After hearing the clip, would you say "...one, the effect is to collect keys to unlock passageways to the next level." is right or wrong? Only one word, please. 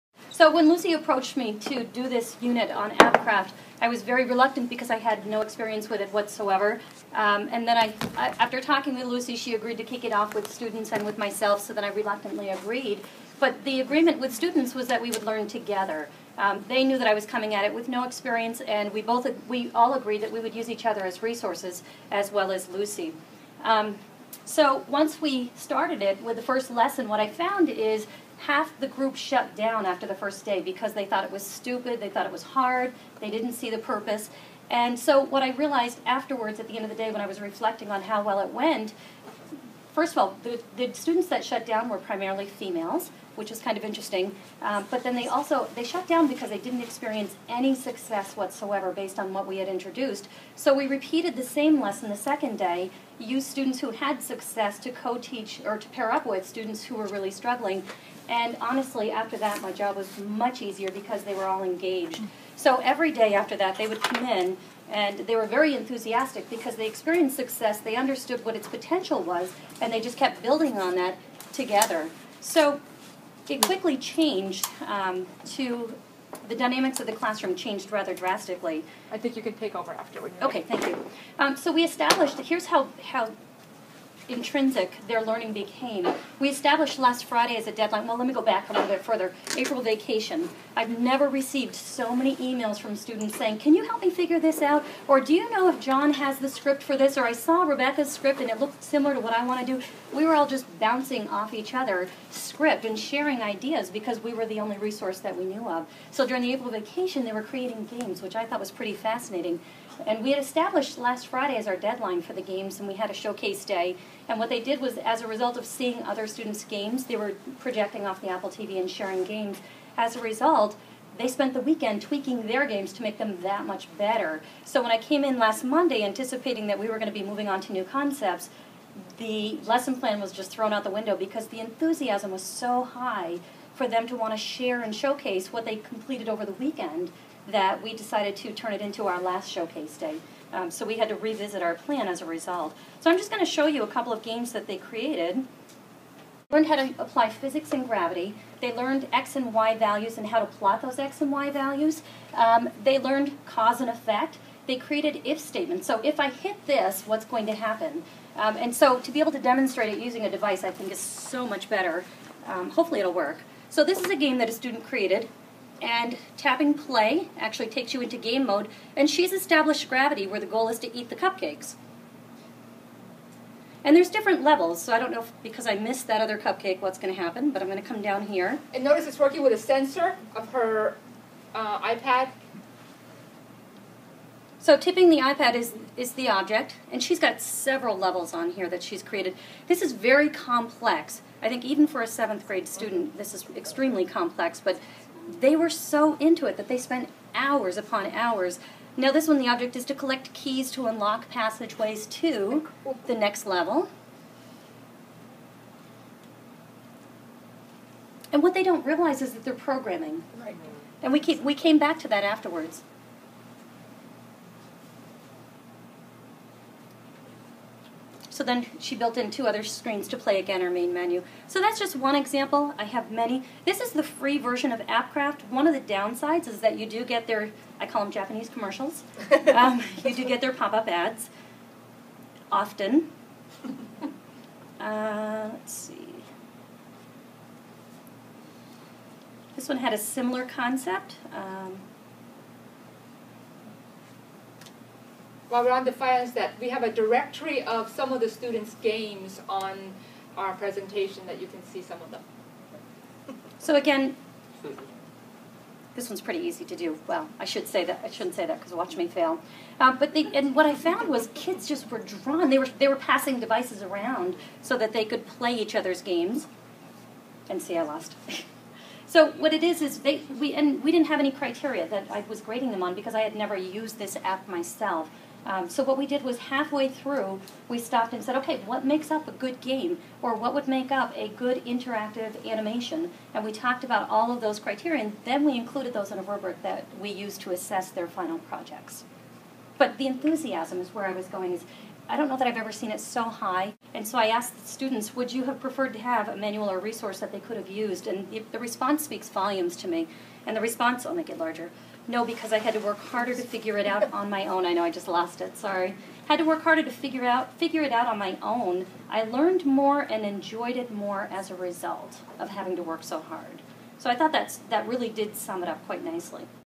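wrong.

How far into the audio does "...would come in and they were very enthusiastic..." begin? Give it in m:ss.
1:03.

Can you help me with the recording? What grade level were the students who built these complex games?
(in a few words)
7th grade.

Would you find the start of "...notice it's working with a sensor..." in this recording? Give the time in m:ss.
2:58.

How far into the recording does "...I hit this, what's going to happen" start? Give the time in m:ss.
2:36.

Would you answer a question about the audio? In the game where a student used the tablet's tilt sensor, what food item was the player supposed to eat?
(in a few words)
cupcakes.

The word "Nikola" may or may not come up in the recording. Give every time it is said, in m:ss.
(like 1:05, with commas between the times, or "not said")
not said.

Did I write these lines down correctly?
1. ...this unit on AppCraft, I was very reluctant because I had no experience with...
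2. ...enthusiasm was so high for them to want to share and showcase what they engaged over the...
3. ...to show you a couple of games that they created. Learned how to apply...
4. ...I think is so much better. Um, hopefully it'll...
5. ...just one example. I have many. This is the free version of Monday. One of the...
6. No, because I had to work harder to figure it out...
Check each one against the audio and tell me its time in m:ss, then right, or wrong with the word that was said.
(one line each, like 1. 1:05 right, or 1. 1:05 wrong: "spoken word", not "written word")
1. 0:02 right
2. 2:11 wrong: "completed", not "engaged"
3. 2:23 right
4. 2:40 right
5. 3:41 wrong: "AppCraft", not "Monday"
6. 5:02 right.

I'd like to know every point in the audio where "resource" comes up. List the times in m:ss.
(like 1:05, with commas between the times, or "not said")
0:21, 1:44, 4:56.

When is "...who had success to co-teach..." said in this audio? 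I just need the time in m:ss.
0:53.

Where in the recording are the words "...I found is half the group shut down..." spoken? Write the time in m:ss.
0:27.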